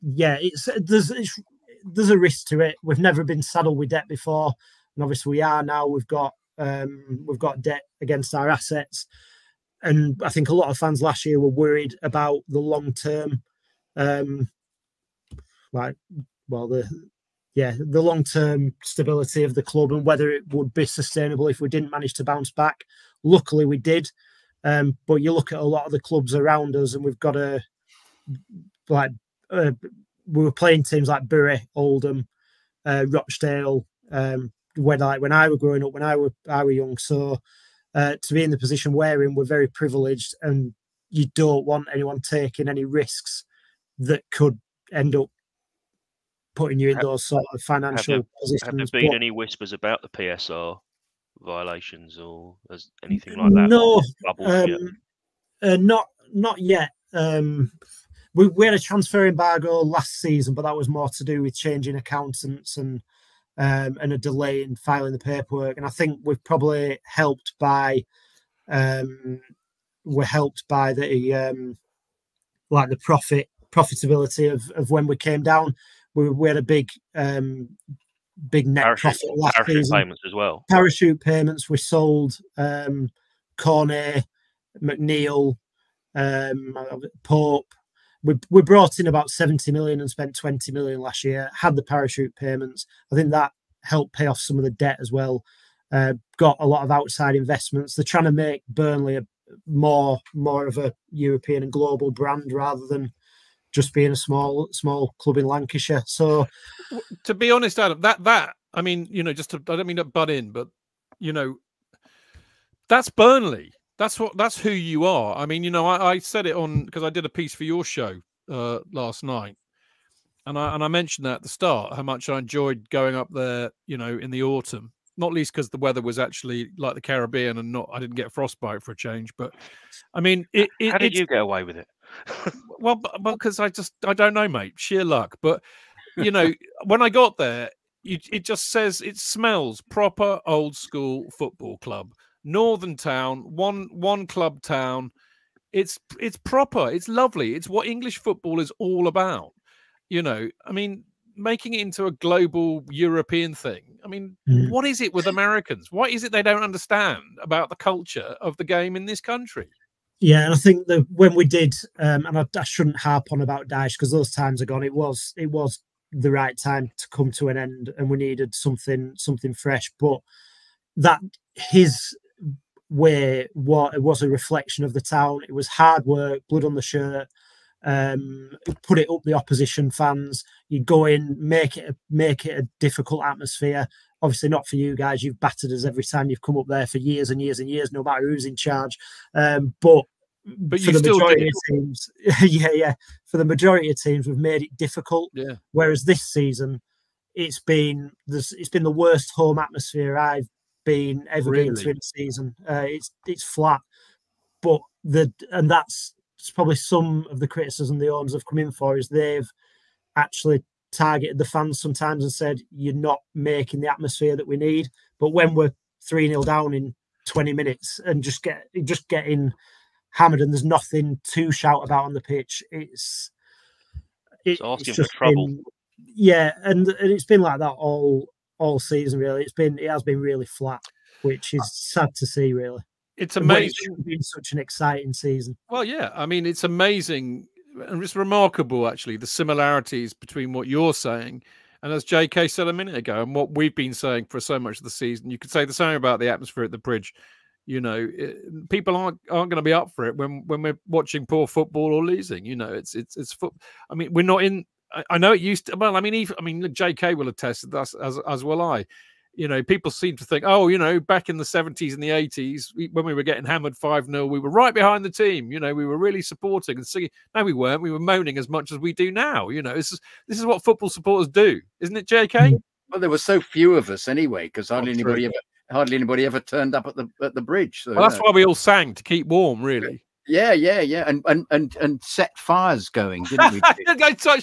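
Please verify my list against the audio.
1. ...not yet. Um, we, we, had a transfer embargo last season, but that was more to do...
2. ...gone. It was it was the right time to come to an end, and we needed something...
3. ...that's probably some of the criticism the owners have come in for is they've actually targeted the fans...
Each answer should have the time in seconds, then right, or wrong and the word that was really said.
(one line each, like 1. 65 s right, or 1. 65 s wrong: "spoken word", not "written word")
1. 56 s right
2. 164 s right
3. 205 s right.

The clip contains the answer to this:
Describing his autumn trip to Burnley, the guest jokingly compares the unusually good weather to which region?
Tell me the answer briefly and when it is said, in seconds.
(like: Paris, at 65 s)
The Caribbean, at 127 s.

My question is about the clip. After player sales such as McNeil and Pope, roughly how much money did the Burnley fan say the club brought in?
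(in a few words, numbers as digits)
70 million.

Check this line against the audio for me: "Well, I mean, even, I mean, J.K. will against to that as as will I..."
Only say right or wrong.
wrong.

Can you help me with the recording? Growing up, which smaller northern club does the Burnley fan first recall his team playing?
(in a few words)
Bury.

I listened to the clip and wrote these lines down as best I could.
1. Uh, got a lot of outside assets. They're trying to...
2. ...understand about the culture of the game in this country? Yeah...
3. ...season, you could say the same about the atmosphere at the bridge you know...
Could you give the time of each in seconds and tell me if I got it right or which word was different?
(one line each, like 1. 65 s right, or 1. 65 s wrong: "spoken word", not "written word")
1. 95 s wrong: "investments", not "assets"
2. 156 s right
3. 244 s right.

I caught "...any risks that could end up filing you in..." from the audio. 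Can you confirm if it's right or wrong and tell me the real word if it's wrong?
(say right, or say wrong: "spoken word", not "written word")
wrong: "putting", not "filing".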